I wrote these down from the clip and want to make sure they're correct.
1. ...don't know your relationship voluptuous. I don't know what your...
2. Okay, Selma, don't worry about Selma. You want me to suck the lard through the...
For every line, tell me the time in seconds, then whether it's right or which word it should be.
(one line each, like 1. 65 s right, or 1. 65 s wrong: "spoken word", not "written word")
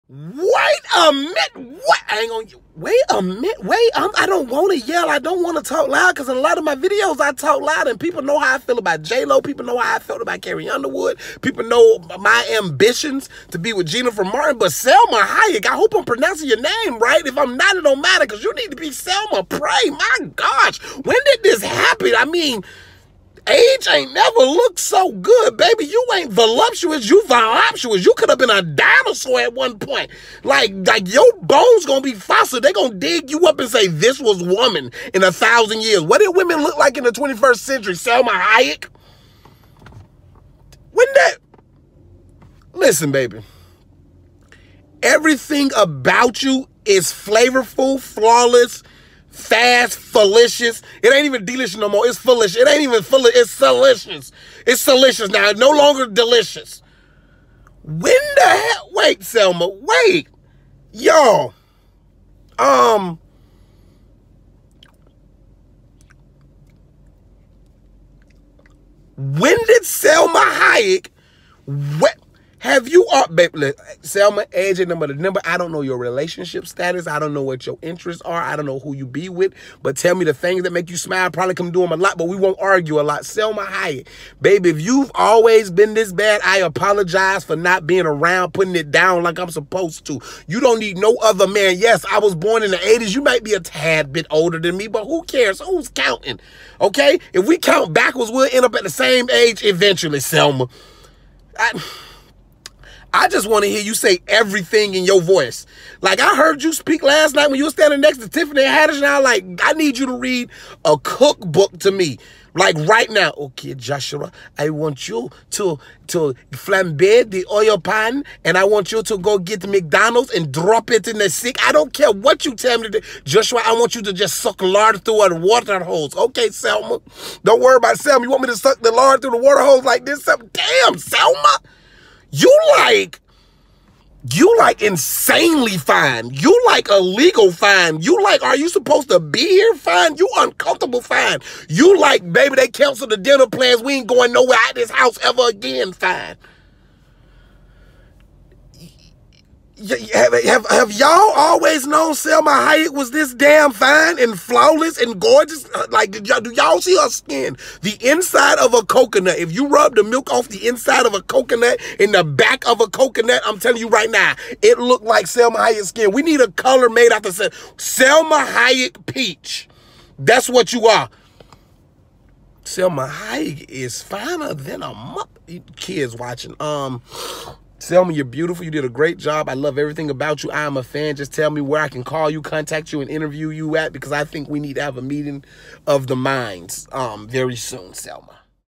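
1. 75 s wrong: "status", not "voluptuous"
2. 126 s right.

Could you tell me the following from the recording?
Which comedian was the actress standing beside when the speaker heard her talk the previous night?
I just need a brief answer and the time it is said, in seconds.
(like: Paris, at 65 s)
Tiffany Haddish, at 108 s.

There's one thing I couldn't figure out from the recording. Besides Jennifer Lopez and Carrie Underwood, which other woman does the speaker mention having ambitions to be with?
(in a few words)
Jennifer Martin.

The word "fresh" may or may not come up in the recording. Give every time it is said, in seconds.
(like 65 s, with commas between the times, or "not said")
not said.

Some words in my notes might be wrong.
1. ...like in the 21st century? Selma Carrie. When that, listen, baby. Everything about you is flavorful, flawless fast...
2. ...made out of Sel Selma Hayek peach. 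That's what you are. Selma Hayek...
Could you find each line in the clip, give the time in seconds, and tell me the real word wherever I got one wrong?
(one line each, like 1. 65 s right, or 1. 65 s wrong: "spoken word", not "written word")
1. 36 s wrong: "Hayek", not "Carrie"
2. 166 s right.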